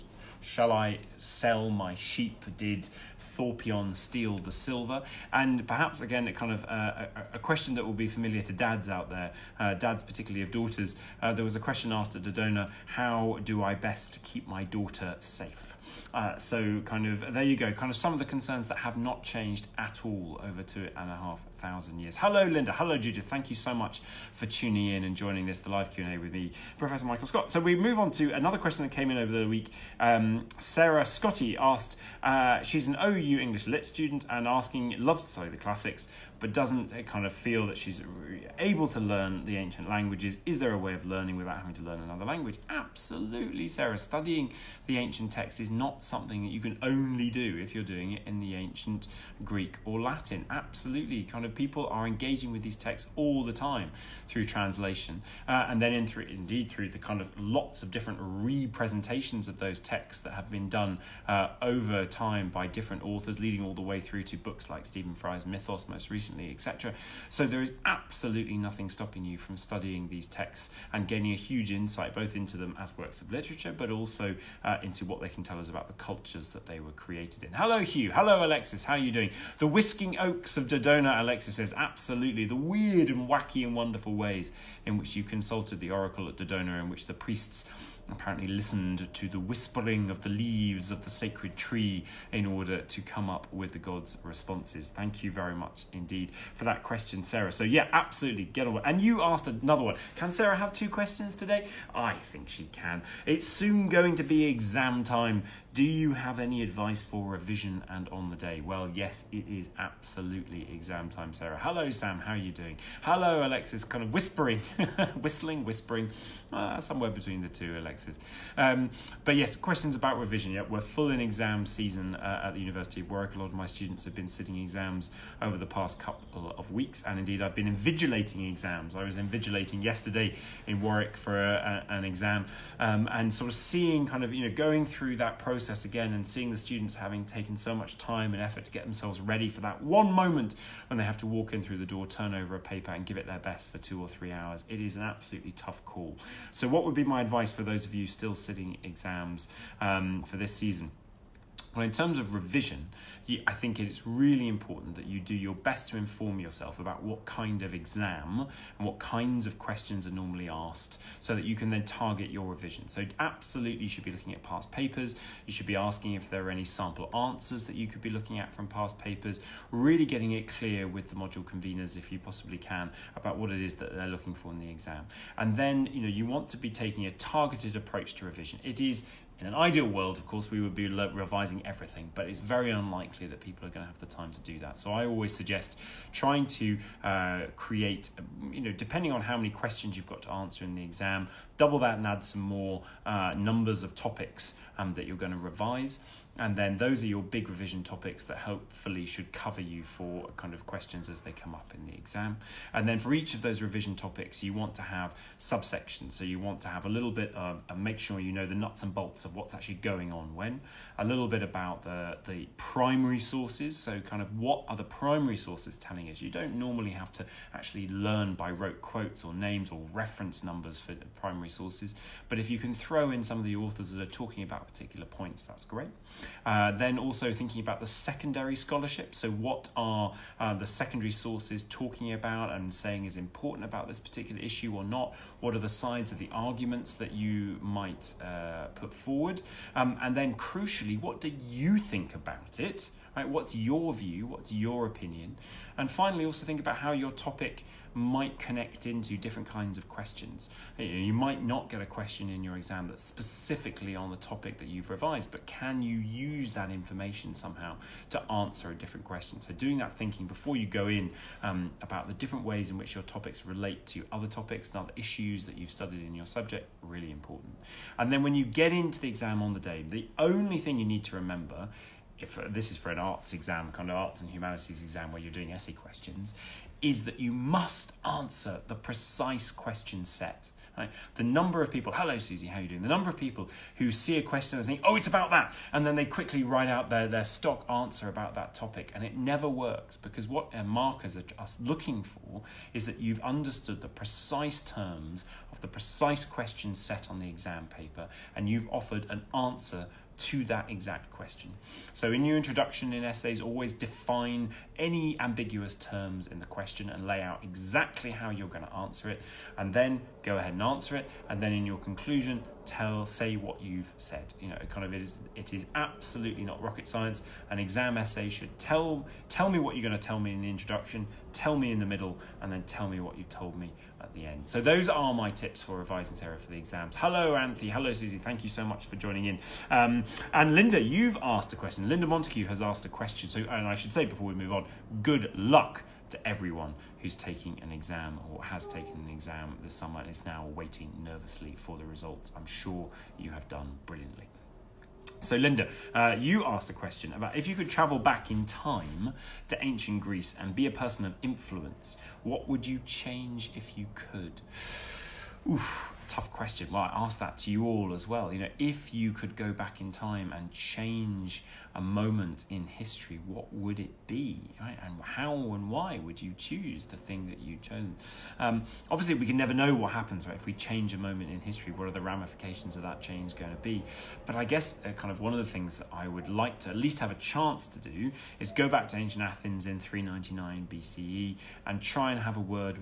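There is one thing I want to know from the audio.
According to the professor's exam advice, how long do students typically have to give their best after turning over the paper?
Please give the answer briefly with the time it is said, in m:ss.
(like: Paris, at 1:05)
2 or 3 hours, at 2:23.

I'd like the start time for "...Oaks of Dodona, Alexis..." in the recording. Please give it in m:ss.
1:20.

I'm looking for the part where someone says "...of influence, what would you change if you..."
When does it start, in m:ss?
5:51.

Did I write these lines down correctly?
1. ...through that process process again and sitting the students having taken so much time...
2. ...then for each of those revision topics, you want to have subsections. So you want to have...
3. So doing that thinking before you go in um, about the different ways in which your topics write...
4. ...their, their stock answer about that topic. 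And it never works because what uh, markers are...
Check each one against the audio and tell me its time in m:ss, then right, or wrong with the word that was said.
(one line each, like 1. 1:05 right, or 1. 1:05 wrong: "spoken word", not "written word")
1. 2:14 wrong: "seeing", not "sitting"
2. 3:22 right
3. 4:19 wrong: "relate", not "write"
4. 4:46 right.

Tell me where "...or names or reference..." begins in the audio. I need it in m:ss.
3:39.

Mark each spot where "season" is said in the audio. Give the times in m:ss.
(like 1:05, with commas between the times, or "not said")
2:01, 2:30.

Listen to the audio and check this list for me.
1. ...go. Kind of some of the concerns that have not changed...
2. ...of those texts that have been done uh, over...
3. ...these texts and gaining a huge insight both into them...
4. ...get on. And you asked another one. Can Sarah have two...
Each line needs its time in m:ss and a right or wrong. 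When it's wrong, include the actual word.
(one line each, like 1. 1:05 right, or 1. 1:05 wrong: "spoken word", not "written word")
1. 0:17 right
2. 0:59 right
3. 1:10 right
4. 1:38 right.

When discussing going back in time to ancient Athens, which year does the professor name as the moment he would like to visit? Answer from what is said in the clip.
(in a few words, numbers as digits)
399 BCE.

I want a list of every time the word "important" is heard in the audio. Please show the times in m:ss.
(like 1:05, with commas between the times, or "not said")
2:34, 3:53, 4:27.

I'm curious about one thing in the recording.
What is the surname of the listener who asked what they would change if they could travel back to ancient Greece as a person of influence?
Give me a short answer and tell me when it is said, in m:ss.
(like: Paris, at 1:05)
Montague, at 5:32.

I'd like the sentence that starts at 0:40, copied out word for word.
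Is there a way of learning without having to learn another language?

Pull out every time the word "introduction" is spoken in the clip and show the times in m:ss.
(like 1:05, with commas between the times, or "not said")
5:02, 5:20.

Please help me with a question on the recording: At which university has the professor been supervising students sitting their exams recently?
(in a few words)
University of Warwick.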